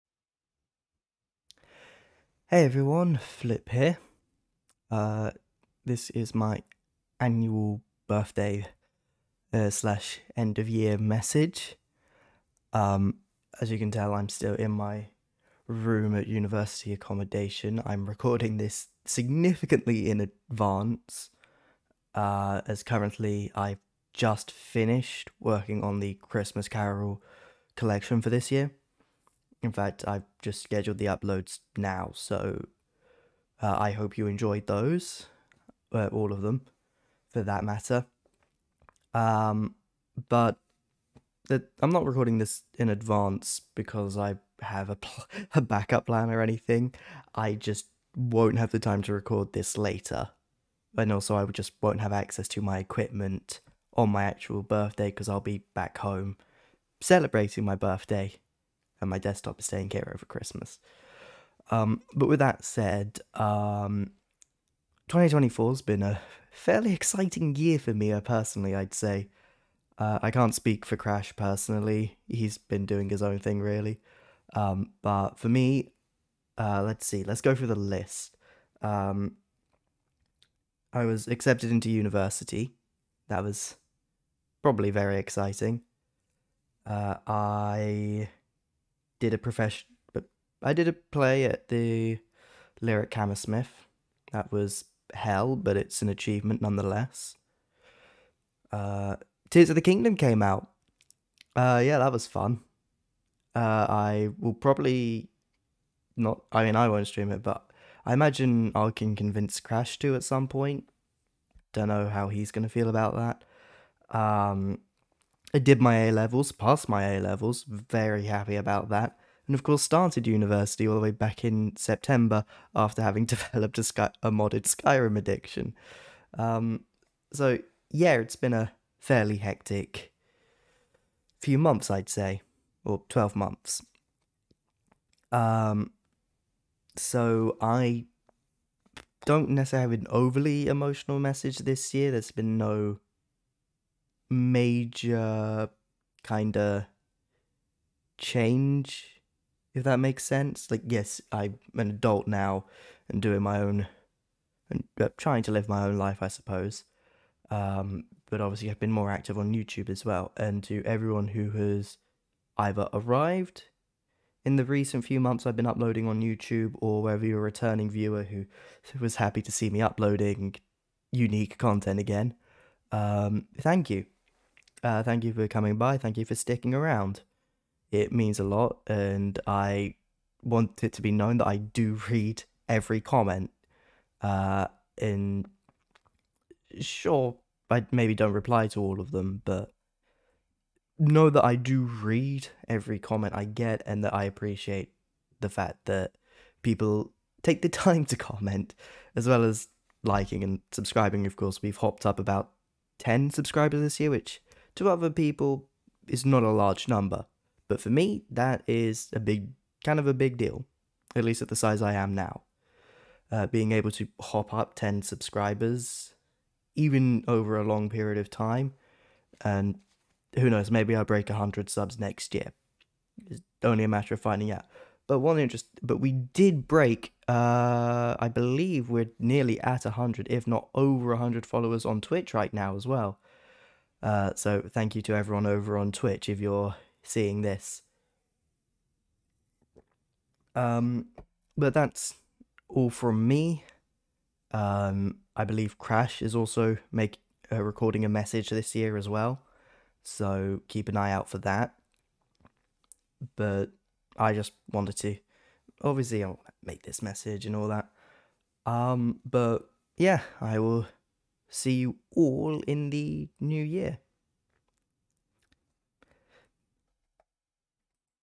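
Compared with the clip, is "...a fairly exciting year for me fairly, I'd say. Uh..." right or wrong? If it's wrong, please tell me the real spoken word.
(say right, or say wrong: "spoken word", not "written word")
wrong: "personally", not "fairly".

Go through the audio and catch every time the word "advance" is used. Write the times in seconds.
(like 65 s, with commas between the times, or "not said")
20 s, 42 s.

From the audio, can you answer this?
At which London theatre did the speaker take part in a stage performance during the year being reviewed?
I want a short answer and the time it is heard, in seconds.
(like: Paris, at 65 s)
Lyric Hammersmith, at 92 s.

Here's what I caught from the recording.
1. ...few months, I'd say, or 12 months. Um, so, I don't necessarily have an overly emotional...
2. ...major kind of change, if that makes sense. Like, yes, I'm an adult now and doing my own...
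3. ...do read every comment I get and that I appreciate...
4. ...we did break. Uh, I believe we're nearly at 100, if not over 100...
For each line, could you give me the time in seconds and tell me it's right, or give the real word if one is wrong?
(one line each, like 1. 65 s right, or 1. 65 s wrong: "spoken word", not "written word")
1. 131 s right
2. 144 s right
3. 191 s right
4. 225 s right.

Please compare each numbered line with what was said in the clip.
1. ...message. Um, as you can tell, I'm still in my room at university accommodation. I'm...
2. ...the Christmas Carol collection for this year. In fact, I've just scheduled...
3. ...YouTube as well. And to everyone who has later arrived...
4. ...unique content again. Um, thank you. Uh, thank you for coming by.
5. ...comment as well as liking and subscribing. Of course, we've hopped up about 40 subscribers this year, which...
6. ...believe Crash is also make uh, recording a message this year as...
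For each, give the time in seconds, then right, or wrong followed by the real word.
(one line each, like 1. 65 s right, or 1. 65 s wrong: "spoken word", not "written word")
1. 10 s right
2. 26 s right
3. 159 s wrong: "either", not "later"
4. 171 s right
5. 198 s wrong: "10", not "40"
6. 245 s right.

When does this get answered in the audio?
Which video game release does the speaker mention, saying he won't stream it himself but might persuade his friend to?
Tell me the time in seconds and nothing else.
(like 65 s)
99 s.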